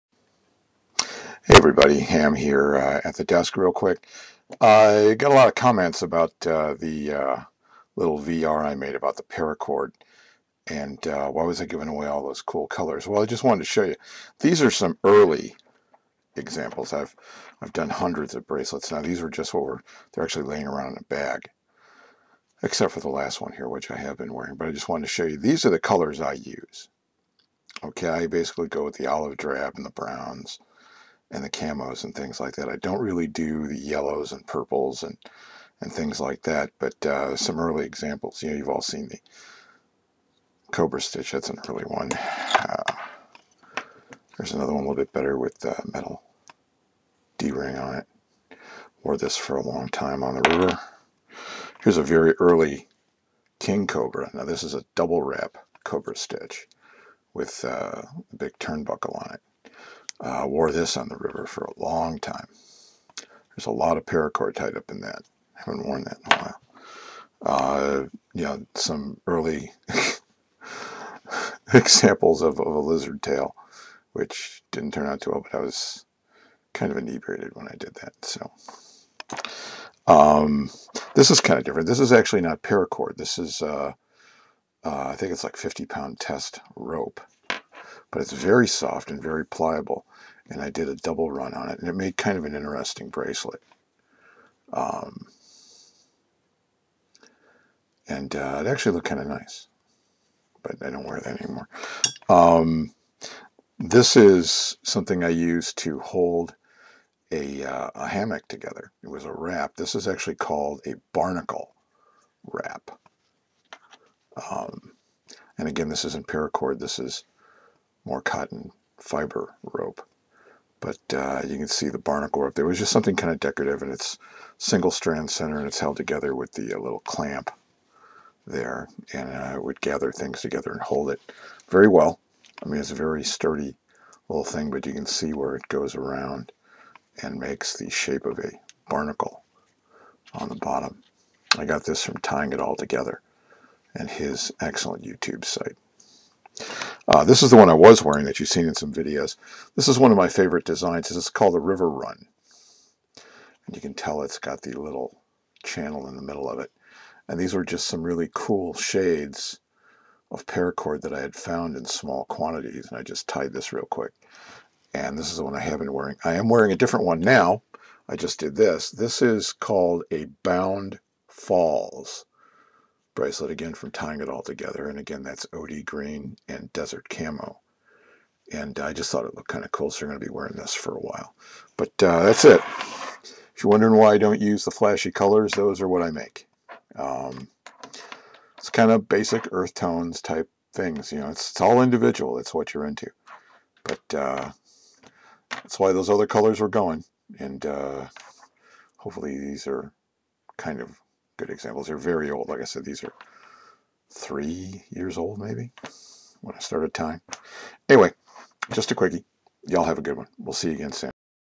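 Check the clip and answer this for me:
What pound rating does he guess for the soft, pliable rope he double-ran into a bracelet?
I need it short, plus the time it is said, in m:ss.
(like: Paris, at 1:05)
50 pound, at 1:25.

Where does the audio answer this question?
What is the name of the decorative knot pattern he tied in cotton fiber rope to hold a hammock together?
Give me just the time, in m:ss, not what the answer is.
1:51.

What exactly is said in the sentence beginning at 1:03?
There's a lot of paracord tied up in that.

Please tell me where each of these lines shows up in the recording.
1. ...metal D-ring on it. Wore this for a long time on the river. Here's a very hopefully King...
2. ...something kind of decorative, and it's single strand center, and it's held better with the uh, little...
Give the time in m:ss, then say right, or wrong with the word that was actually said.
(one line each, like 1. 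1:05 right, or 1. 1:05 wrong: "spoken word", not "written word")
1. 0:45 wrong: "early", not "hopefully"
2. 2:02 wrong: "together", not "better".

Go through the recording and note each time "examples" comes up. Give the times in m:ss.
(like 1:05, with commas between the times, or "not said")
0:16, 0:37, 1:11, 3:21.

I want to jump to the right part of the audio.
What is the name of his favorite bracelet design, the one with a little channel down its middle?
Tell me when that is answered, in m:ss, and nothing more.
2:31.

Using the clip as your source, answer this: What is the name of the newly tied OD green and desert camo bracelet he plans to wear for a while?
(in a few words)
Bound Falls.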